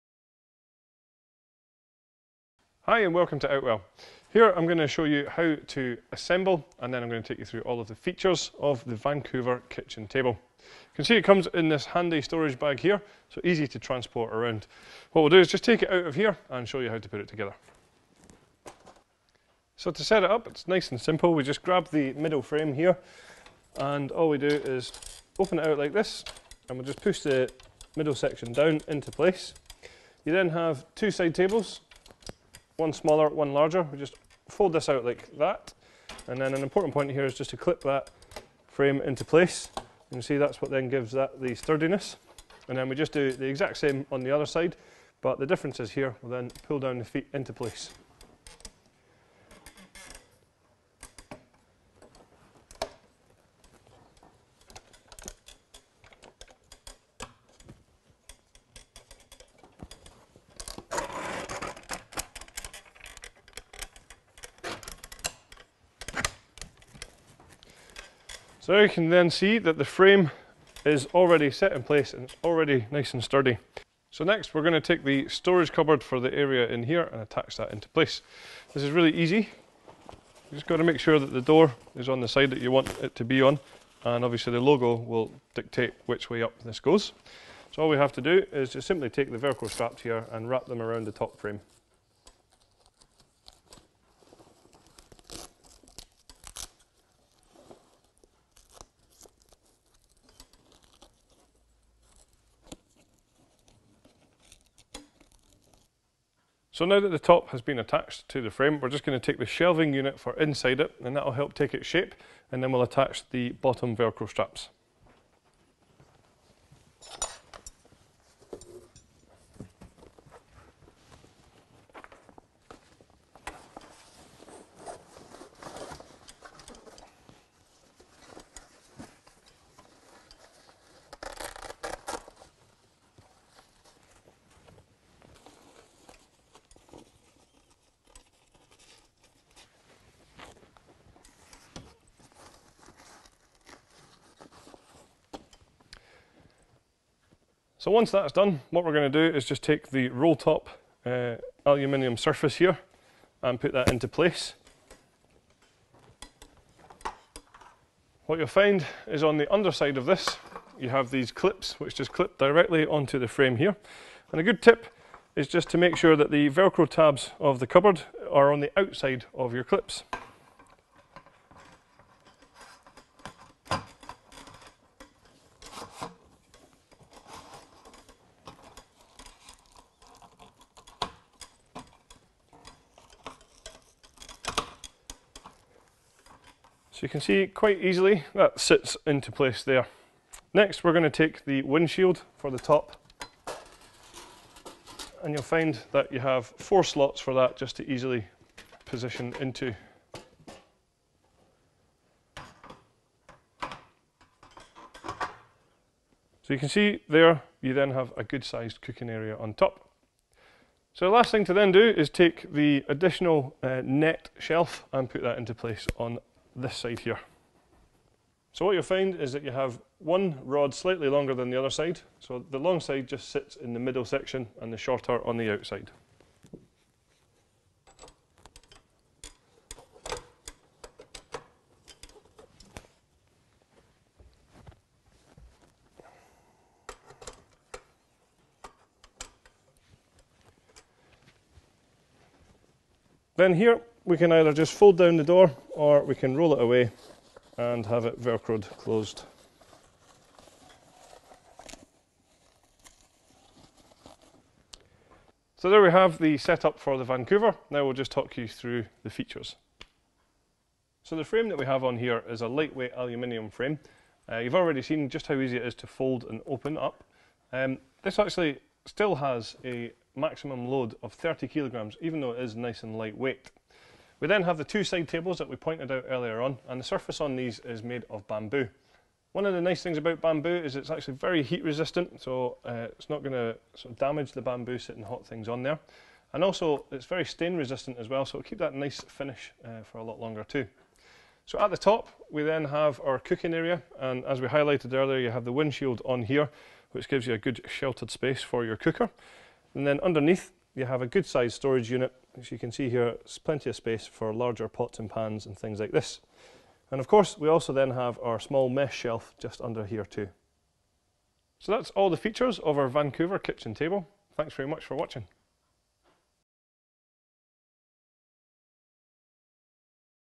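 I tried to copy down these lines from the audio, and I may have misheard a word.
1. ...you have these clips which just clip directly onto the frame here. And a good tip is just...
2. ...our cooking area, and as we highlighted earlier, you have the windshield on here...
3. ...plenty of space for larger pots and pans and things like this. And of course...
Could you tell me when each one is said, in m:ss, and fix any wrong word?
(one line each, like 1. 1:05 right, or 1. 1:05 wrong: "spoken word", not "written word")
1. 2:40 right
2. 4:53 right
3. 5:03 right.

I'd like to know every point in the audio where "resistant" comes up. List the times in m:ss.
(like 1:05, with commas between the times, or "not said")
4:41, 4:47.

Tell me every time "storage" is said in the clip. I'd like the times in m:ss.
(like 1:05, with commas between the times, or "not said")
0:12, 1:15, 5:01.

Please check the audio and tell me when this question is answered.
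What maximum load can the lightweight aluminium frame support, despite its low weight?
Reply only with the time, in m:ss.
4:31.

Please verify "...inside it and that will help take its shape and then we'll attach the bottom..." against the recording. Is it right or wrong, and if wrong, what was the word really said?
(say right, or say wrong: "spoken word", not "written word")
right.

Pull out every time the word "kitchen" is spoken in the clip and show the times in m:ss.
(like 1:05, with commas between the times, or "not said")
0:09, 5:13.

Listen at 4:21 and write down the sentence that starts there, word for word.
So the frame that we have on here is a lightweight aluminium frame.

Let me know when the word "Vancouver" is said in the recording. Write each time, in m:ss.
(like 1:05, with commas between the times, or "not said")
0:08, 4:17, 5:12.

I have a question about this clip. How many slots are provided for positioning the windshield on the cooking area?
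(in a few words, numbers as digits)
4.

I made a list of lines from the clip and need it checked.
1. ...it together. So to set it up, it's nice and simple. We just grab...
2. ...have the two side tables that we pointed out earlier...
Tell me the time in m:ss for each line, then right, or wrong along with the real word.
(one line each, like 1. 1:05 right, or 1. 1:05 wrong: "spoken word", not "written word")
1. 0:17 right
2. 4:34 right.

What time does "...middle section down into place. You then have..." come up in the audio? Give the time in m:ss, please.
0:27.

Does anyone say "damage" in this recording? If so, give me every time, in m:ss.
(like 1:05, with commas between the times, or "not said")
4:43.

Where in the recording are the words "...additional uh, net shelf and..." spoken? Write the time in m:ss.
3:32.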